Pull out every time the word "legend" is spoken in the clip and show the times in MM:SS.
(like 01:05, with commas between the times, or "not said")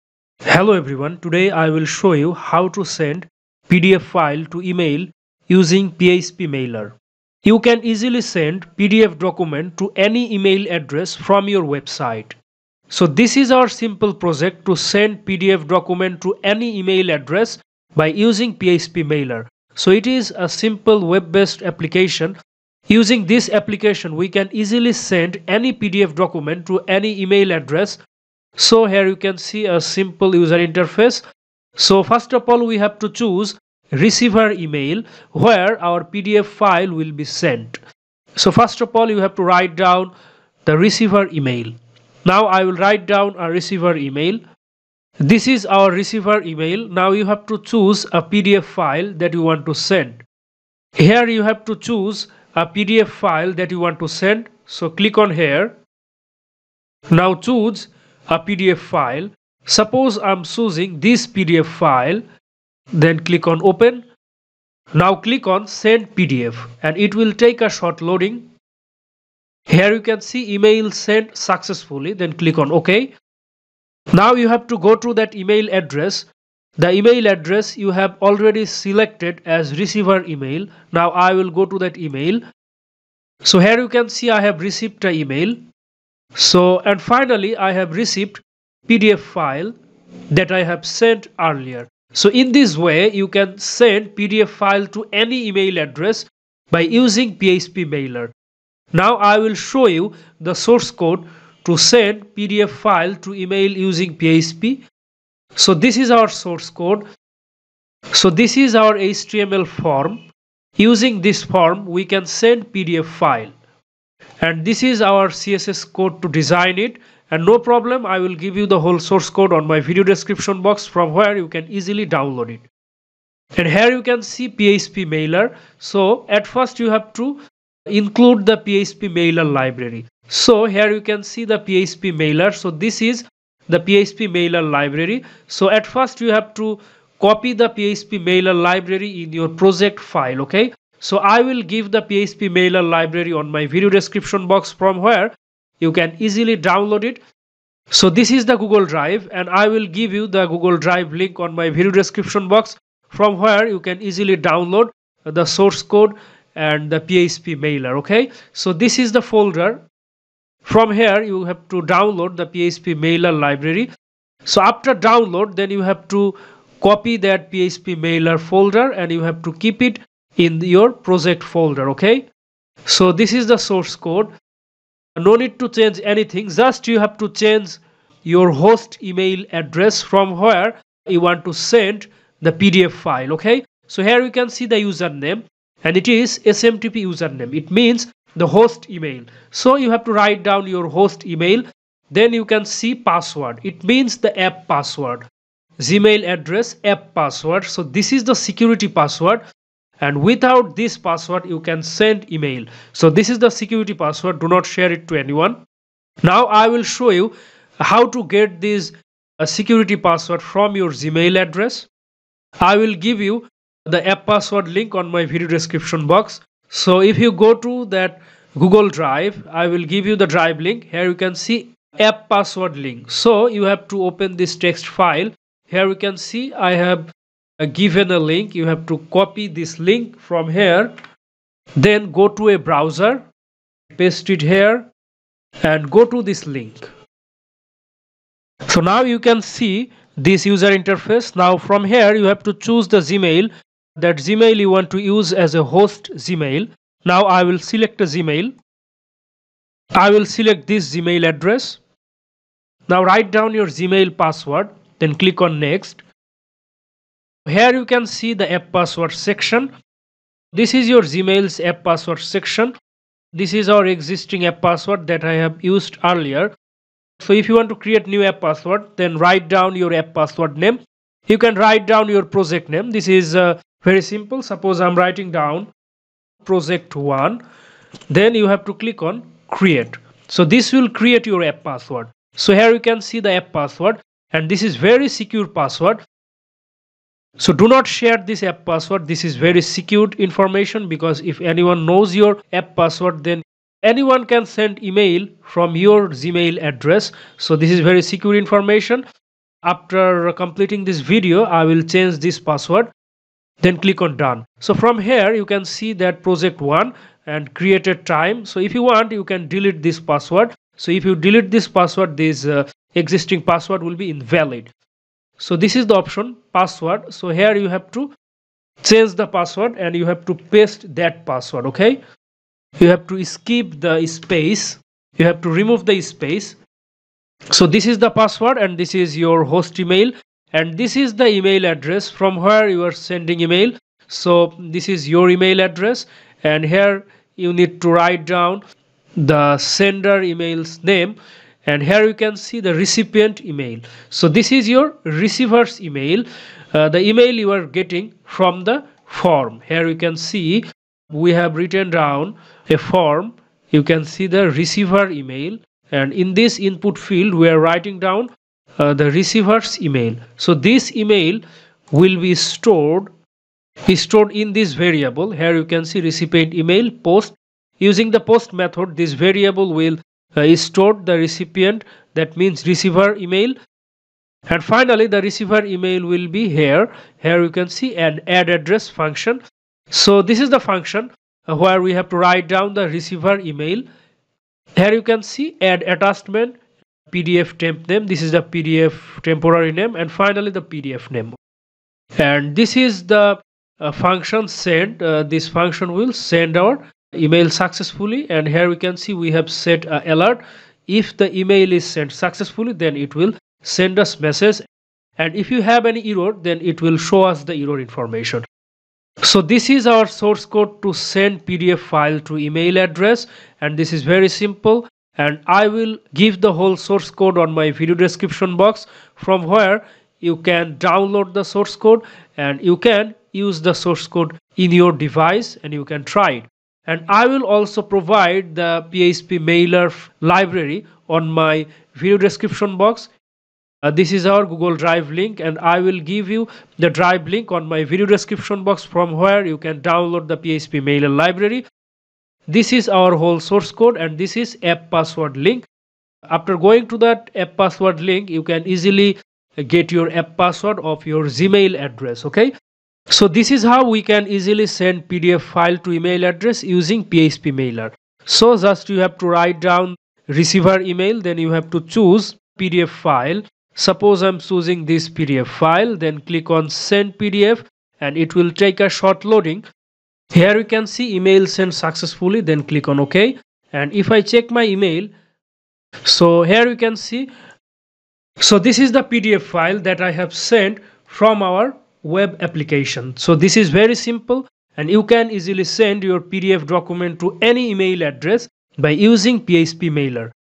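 not said.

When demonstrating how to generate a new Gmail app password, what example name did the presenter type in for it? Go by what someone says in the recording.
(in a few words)
project 1.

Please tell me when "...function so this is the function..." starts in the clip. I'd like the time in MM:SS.
06:18.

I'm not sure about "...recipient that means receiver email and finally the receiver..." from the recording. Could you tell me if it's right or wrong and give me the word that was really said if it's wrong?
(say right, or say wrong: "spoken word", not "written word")
right.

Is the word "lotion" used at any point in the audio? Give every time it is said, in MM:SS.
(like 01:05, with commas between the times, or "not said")
not said.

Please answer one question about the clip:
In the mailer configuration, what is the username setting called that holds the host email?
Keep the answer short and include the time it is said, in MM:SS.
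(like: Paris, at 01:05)
SMTP username, at 03:06.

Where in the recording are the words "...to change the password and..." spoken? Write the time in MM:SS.
05:17.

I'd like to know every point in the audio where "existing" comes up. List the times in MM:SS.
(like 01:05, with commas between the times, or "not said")
04:23, 05:12.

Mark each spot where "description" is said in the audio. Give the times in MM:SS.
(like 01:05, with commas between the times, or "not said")
02:00, 02:23, 02:31, 03:35, 06:57, 07:12, 07:18.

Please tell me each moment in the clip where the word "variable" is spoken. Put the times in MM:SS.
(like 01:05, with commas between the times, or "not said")
06:04, 06:09.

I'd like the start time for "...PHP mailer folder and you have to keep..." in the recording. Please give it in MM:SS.
02:47.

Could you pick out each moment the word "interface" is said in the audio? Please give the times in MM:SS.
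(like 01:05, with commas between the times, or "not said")
00:30, 04:00.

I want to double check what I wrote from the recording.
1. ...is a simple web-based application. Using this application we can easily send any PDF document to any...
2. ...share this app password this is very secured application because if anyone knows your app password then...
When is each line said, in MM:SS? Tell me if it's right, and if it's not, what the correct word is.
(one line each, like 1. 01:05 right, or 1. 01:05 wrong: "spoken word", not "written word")
1. 00:20 right
2. 04:47 wrong: "information", not "application".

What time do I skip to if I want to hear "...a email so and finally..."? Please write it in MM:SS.
01:25.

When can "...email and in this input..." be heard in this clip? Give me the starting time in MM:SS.
05:55.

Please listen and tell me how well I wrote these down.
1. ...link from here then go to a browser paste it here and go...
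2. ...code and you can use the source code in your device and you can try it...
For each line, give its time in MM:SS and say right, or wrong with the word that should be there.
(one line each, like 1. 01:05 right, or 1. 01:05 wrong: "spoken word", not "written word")
1. 03:49 right
2. 07:01 right.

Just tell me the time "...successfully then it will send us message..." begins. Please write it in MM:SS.
06:42.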